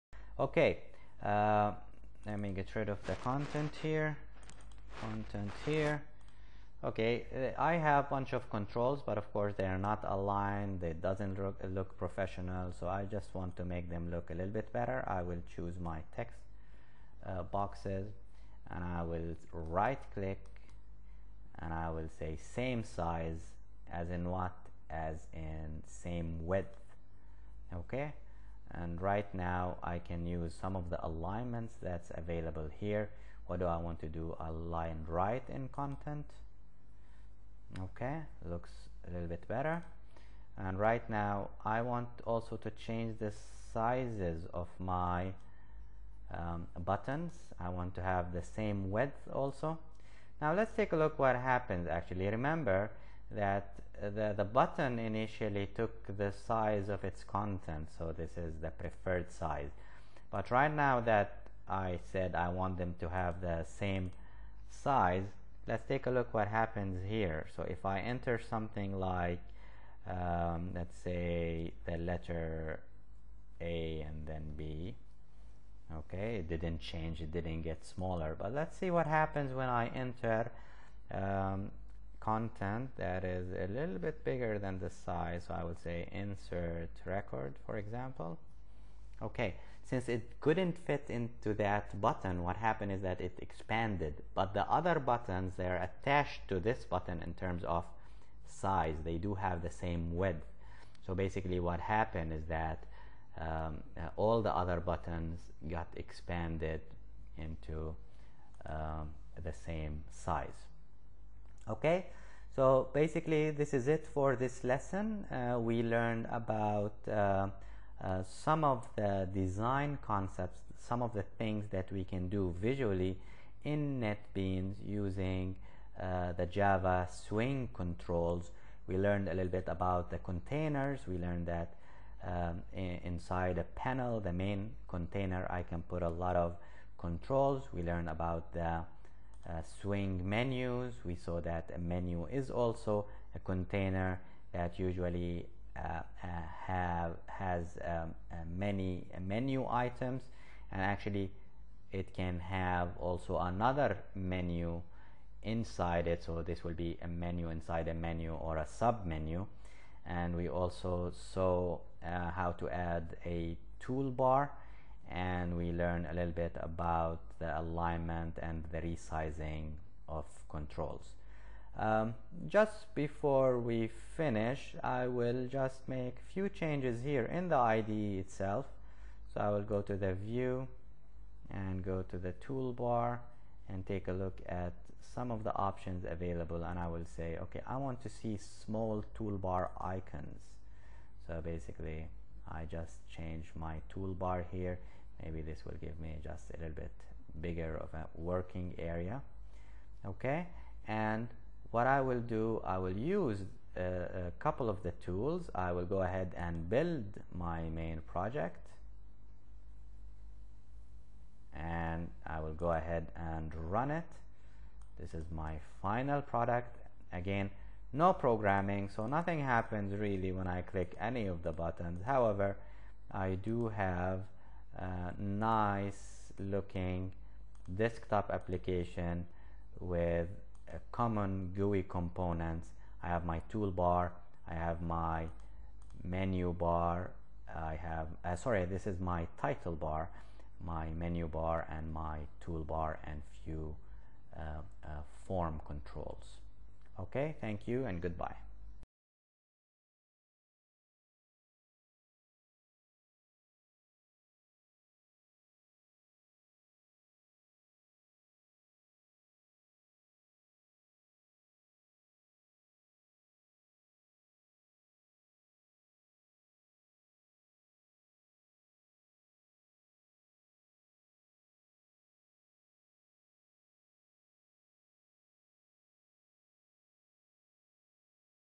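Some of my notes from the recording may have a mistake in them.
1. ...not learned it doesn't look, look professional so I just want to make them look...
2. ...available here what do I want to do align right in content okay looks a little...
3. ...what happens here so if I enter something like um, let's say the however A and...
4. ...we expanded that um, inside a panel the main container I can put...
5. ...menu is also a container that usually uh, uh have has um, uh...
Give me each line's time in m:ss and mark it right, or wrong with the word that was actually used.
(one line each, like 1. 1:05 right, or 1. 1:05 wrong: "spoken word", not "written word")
1. 0:09 wrong: "aligned", not "learned"
2. 0:32 right
3. 1:06 wrong: "letter", not "however"
4. 2:11 wrong: "learned", not "expanded"
5. 2:21 right.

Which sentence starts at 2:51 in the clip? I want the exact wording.
Um, just before we finish, I will just make few changes here in the IDE itself.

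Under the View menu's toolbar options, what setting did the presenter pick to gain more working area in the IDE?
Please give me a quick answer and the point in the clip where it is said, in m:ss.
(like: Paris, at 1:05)
small toolbar icons, at 3:08.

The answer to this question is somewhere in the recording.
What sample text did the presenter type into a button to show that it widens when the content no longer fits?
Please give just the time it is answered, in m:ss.
1:26.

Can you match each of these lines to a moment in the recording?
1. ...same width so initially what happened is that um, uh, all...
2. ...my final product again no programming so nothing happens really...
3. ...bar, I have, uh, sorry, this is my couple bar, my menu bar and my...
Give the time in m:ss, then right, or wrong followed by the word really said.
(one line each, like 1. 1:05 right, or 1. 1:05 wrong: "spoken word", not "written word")
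1. 1:39 wrong: "basically", not "initially"
2. 3:35 right
3. 3:56 wrong: "title", not "couple".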